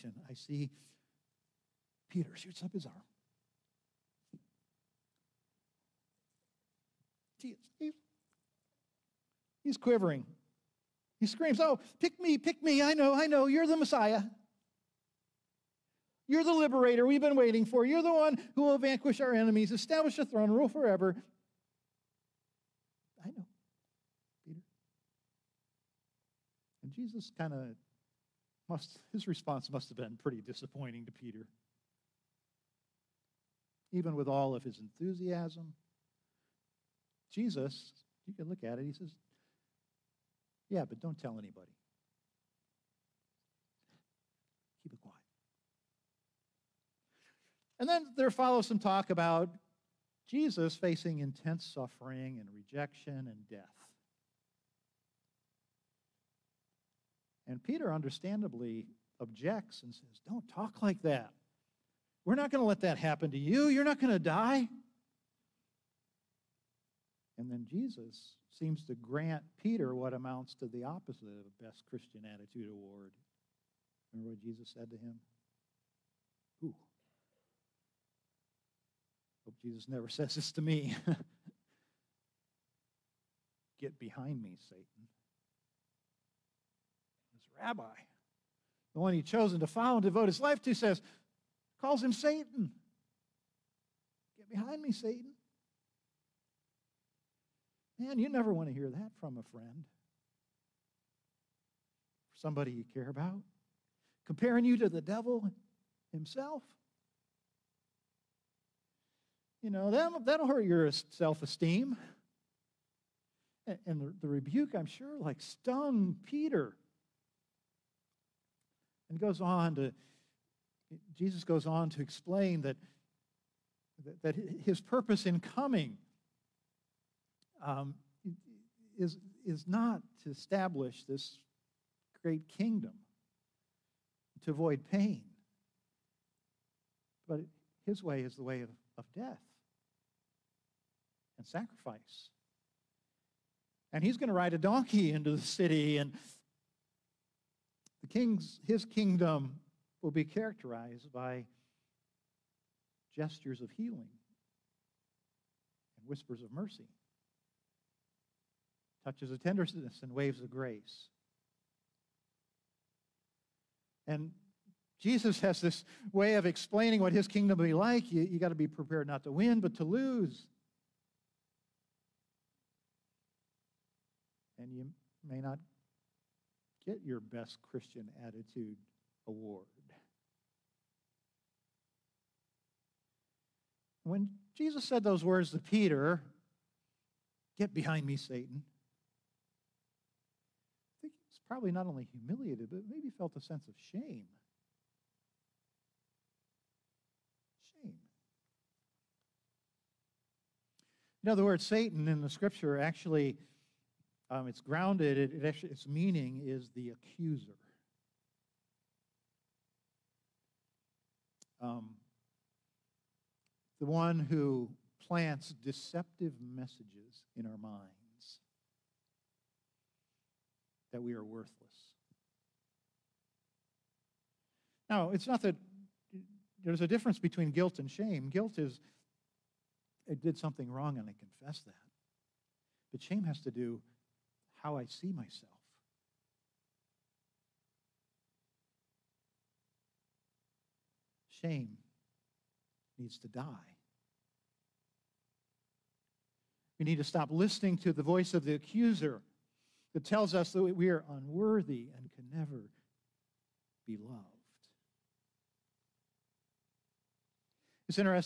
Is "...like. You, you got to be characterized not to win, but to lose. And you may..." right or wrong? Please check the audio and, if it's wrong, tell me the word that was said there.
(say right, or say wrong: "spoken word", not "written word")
wrong: "prepared", not "characterized".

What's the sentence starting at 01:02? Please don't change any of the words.
We're not going to let that happen to you.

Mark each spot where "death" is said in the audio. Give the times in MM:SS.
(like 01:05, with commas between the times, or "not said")
00:53, 02:19.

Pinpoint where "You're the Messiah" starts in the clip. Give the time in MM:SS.
00:13.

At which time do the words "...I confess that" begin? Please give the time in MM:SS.
03:51.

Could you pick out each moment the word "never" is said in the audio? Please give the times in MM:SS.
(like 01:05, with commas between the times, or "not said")
01:19, 01:38, 04:12.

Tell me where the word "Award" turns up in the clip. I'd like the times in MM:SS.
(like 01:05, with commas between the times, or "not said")
01:12, 02:59.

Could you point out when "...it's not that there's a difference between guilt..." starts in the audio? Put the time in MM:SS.
03:45.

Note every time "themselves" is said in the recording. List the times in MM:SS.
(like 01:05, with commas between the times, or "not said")
not said.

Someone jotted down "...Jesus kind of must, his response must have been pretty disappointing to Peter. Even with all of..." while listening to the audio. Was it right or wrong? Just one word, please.
right.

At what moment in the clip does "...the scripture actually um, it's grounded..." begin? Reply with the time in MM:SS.
03:22.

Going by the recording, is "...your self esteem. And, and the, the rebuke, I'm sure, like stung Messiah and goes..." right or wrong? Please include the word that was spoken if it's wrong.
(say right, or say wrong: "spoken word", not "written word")
wrong: "Peter", not "Messiah".